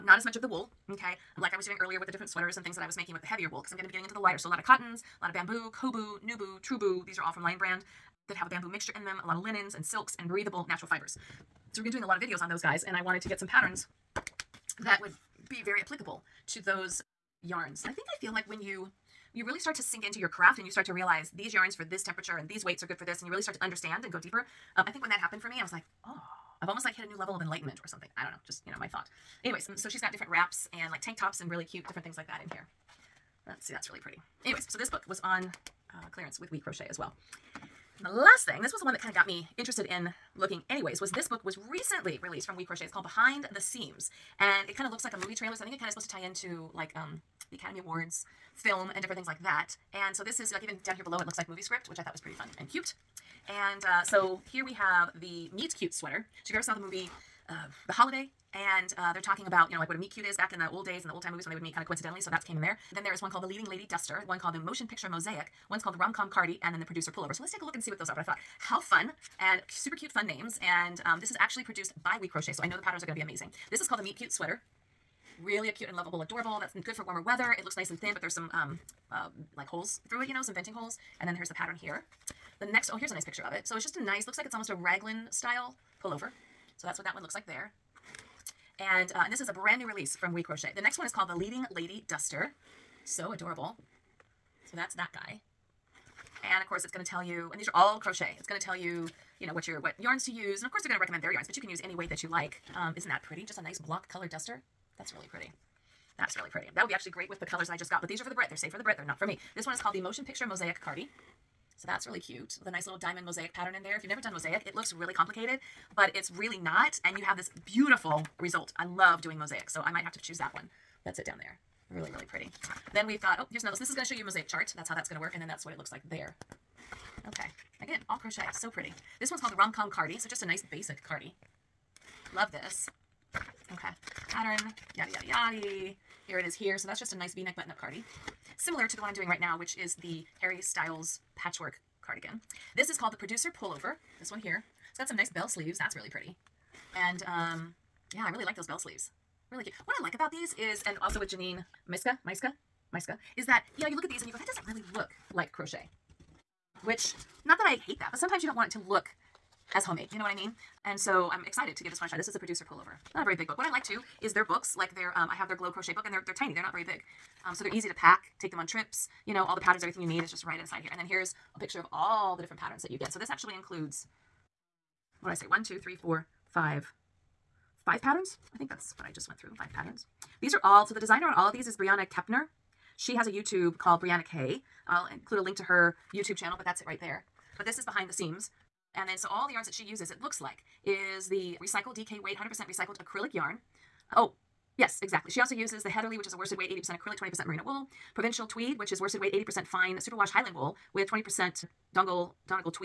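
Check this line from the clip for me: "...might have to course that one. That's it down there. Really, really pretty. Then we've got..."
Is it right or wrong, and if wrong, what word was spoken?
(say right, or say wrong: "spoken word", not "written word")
wrong: "choose", not "course".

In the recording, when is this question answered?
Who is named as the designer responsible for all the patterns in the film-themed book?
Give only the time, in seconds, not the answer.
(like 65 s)
181 s.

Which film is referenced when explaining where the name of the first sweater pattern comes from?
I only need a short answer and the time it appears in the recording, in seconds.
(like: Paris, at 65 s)
The Holiday, at 57 s.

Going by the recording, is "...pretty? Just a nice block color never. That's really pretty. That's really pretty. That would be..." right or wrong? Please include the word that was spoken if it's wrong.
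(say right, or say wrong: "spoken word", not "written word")
wrong: "duster", not "never".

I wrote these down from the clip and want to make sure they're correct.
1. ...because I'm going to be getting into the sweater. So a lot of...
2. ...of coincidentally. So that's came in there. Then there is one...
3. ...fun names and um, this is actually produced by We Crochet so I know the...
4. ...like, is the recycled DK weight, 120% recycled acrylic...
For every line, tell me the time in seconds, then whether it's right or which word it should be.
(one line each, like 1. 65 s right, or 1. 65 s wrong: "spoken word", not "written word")
1. 3 s wrong: "lighter", not "sweater"
2. 61 s right
3. 70 s right
4. 190 s wrong: "100", not "120".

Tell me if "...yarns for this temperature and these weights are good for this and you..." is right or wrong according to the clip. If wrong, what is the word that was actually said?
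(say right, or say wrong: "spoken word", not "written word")
right.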